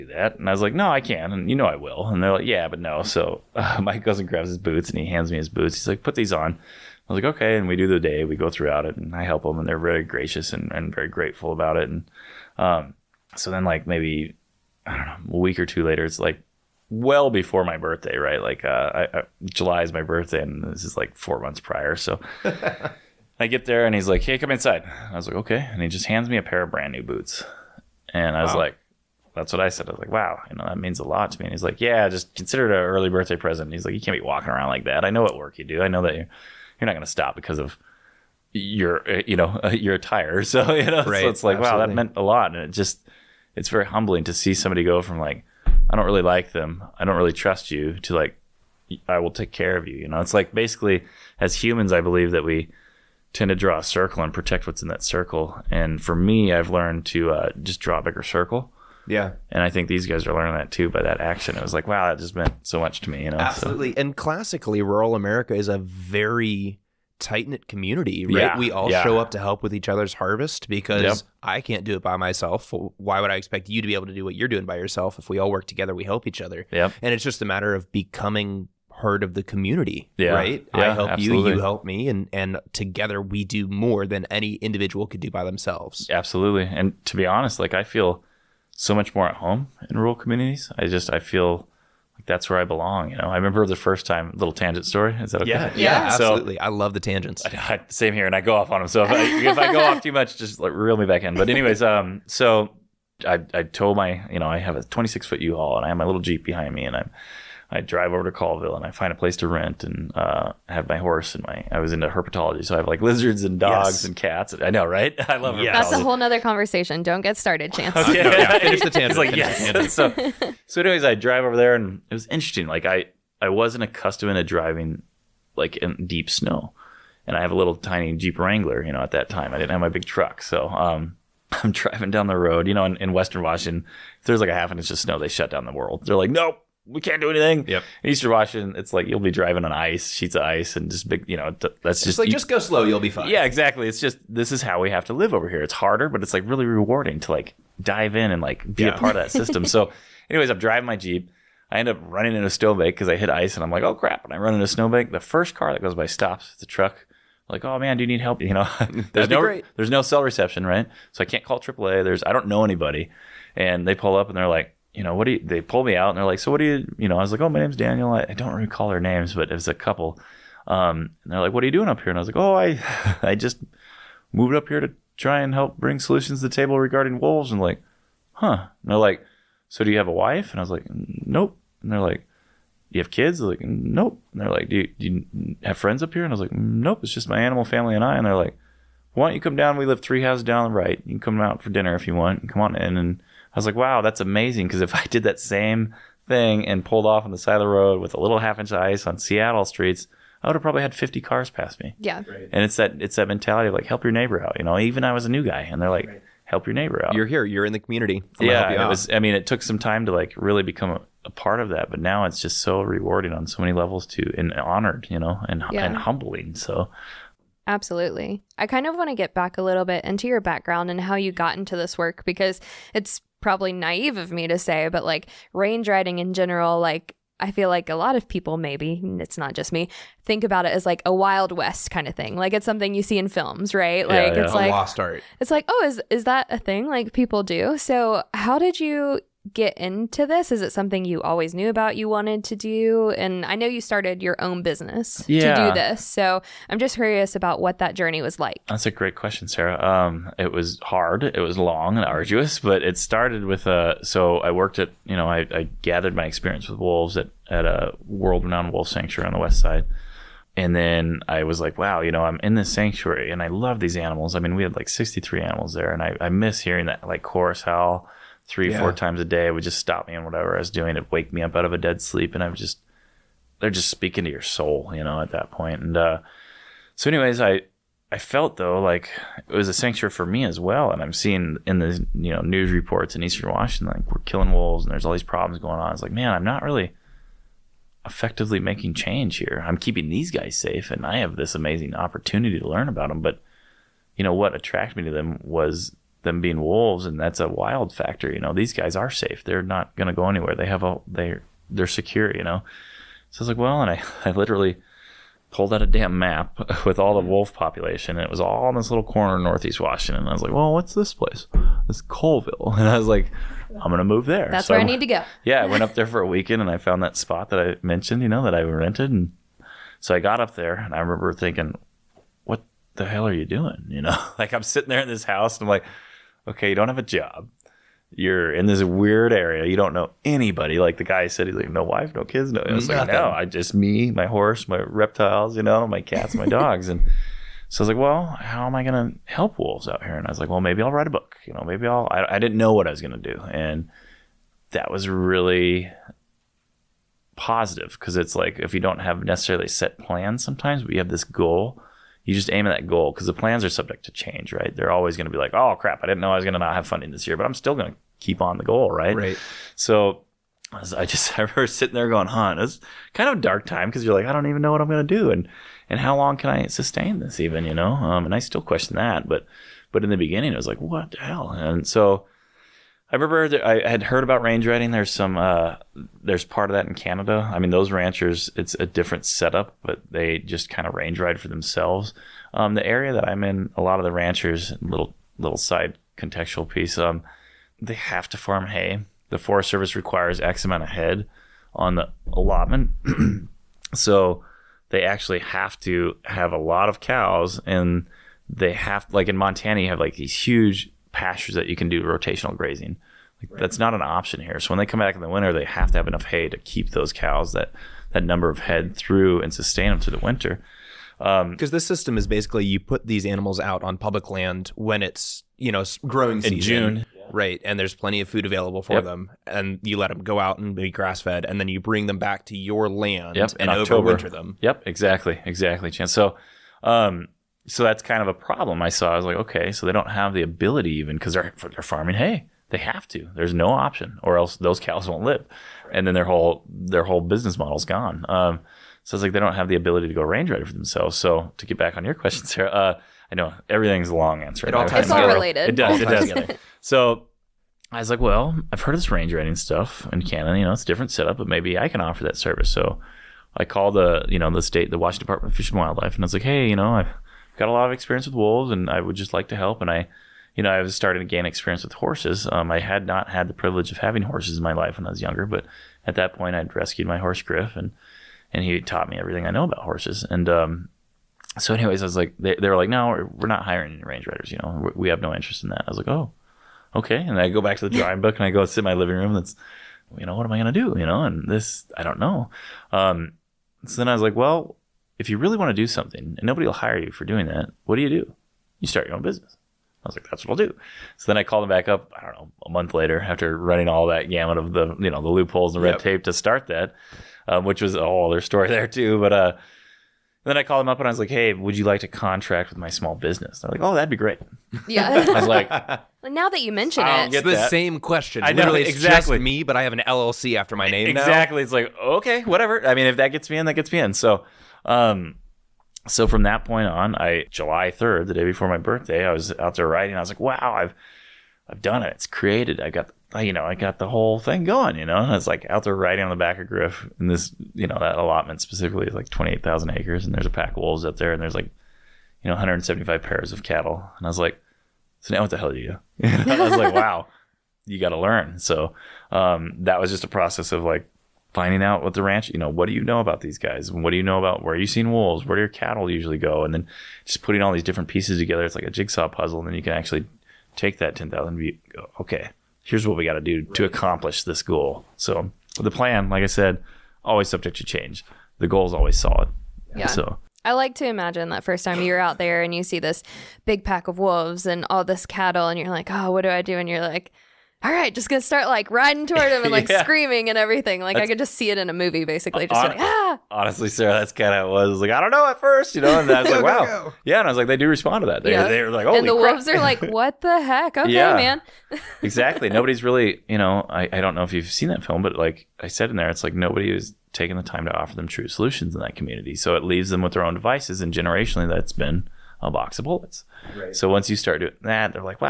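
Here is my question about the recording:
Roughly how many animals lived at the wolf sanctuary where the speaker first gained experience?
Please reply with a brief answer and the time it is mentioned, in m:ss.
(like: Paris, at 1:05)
63, at 4:24.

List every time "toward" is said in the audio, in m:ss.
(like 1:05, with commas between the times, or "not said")
9:29.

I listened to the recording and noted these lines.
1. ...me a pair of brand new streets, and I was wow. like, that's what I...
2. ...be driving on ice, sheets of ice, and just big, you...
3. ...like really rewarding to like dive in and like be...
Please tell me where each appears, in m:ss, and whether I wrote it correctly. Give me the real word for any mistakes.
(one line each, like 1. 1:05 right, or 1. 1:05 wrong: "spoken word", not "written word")
1. 0:26 wrong: "boots", not "streets"
2. 2:19 right
3. 2:26 right.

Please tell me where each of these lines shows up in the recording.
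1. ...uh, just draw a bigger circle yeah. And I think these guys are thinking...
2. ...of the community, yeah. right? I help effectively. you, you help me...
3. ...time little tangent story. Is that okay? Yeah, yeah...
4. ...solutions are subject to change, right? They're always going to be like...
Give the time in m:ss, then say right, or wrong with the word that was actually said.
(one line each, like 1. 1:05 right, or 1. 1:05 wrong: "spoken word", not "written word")
1. 0:57 wrong: "learning", not "thinking"
2. 1:19 wrong: "absolutely", not "effectively"
3. 1:34 right
4. 5:53 wrong: "plans", not "solutions".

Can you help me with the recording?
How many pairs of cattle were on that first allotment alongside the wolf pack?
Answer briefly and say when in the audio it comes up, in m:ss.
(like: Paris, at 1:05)
175, at 8:52.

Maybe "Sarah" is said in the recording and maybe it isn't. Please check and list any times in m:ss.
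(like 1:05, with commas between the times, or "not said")
4:09, 7:22, 9:33.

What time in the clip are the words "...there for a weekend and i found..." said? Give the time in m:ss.
5:15.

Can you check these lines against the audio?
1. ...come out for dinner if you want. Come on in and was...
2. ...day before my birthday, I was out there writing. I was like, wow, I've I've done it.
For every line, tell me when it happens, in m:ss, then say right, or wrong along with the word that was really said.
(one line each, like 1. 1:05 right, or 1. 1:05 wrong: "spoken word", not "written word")
1. 3:11 right
2. 8:38 right.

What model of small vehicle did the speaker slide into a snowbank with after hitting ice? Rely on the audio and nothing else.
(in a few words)
Jeep Wrangler.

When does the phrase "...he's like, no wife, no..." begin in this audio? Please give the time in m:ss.
5:31.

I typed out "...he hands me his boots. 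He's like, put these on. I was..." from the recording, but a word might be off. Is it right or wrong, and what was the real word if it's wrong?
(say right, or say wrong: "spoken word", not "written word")
right.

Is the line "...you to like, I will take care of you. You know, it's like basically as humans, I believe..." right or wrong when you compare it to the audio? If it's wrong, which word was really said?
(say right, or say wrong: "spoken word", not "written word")
right.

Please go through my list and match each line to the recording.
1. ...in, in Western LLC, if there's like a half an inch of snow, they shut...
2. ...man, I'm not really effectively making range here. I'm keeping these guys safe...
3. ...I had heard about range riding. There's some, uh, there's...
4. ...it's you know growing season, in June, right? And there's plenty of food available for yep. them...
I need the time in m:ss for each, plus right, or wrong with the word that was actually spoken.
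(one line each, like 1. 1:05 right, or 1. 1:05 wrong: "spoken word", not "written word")
1. 2:12 wrong: "Washington", not "LLC"
2. 4:46 wrong: "change", not "range"
3. 6:13 right
4. 6:55 right.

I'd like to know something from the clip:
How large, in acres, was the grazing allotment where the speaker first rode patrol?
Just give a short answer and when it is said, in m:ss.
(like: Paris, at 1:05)
28,000 acres, at 8:49.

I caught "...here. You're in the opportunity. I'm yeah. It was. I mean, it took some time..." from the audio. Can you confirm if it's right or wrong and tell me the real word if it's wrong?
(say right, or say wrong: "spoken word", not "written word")
wrong: "community", not "opportunity".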